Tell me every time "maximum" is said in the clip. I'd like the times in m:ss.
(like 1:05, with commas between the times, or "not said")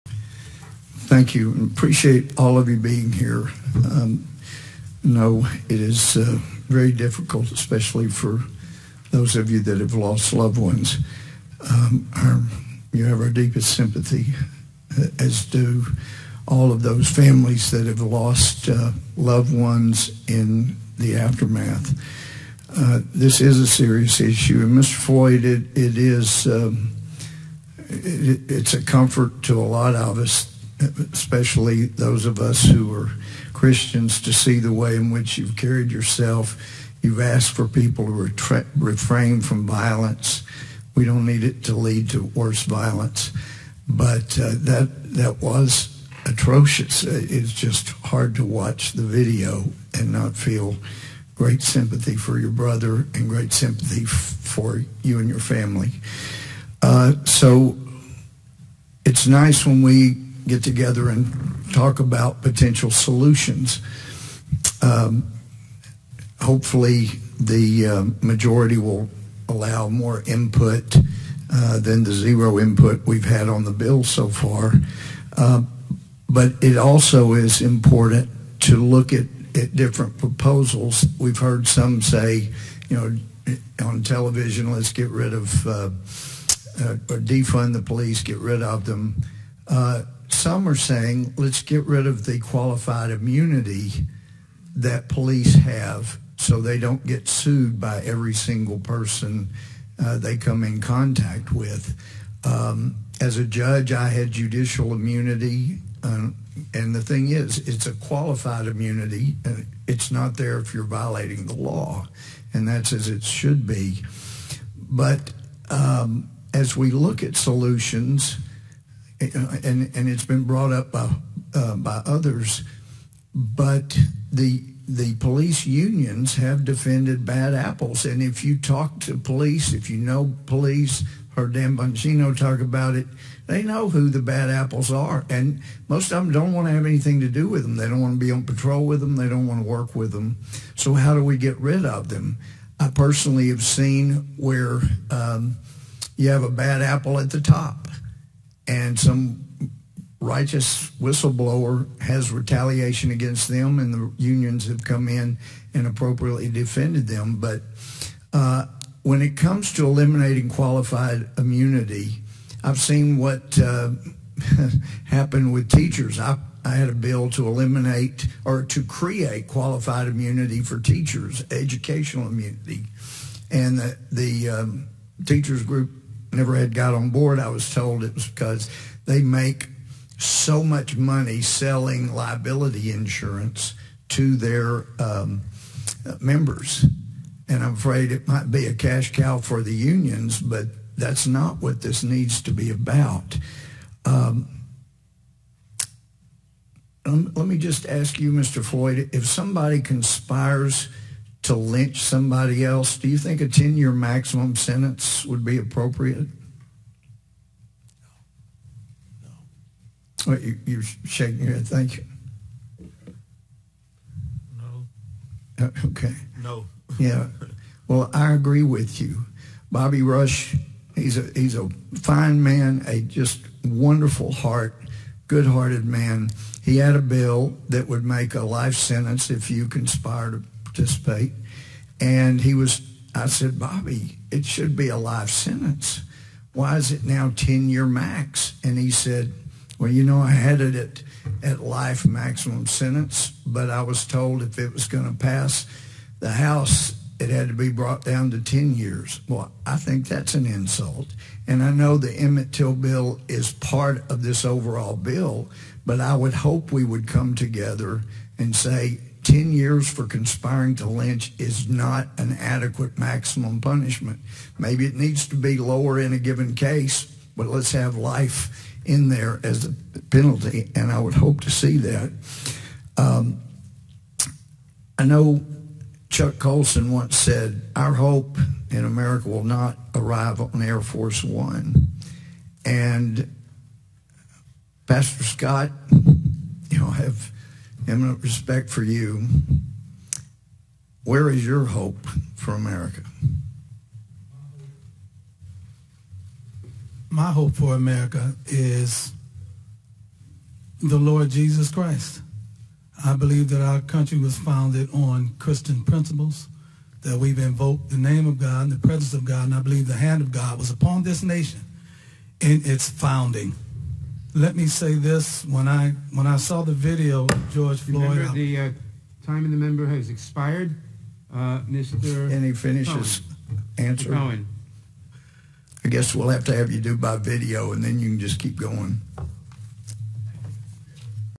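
3:23, 4:02, 4:22.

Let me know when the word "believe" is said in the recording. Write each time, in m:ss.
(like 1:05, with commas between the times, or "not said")
5:03, 5:09.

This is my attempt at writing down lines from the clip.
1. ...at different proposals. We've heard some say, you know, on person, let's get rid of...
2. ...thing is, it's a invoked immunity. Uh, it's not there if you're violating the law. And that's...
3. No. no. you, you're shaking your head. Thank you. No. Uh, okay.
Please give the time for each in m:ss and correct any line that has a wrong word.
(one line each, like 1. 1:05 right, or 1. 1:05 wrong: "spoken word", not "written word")
1. 1:19 wrong: "television", not "person"
2. 1:47 wrong: "qualified", not "invoked"
3. 3:30 right.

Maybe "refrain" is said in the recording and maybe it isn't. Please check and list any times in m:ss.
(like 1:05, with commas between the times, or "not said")
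0:38.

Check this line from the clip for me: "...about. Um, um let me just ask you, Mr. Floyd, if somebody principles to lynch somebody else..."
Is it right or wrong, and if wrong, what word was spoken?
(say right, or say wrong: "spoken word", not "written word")
wrong: "conspires", not "principles".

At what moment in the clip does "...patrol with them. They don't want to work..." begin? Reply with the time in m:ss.
2:18.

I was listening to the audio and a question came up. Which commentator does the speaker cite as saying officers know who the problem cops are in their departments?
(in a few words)
Dan Bongino.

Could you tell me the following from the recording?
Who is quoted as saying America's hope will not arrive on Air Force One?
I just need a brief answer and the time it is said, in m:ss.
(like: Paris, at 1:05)
Chuck Colson, at 4:36.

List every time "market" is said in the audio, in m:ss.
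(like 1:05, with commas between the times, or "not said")
not said.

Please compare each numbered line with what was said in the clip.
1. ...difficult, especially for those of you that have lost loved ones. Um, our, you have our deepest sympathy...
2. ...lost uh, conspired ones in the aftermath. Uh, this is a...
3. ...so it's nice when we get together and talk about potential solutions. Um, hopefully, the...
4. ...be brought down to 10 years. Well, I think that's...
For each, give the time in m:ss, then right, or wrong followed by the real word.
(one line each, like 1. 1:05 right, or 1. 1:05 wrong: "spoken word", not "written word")
1. 0:06 right
2. 0:17 wrong: "loved", not "conspired"
3. 0:57 right
4. 4:07 right.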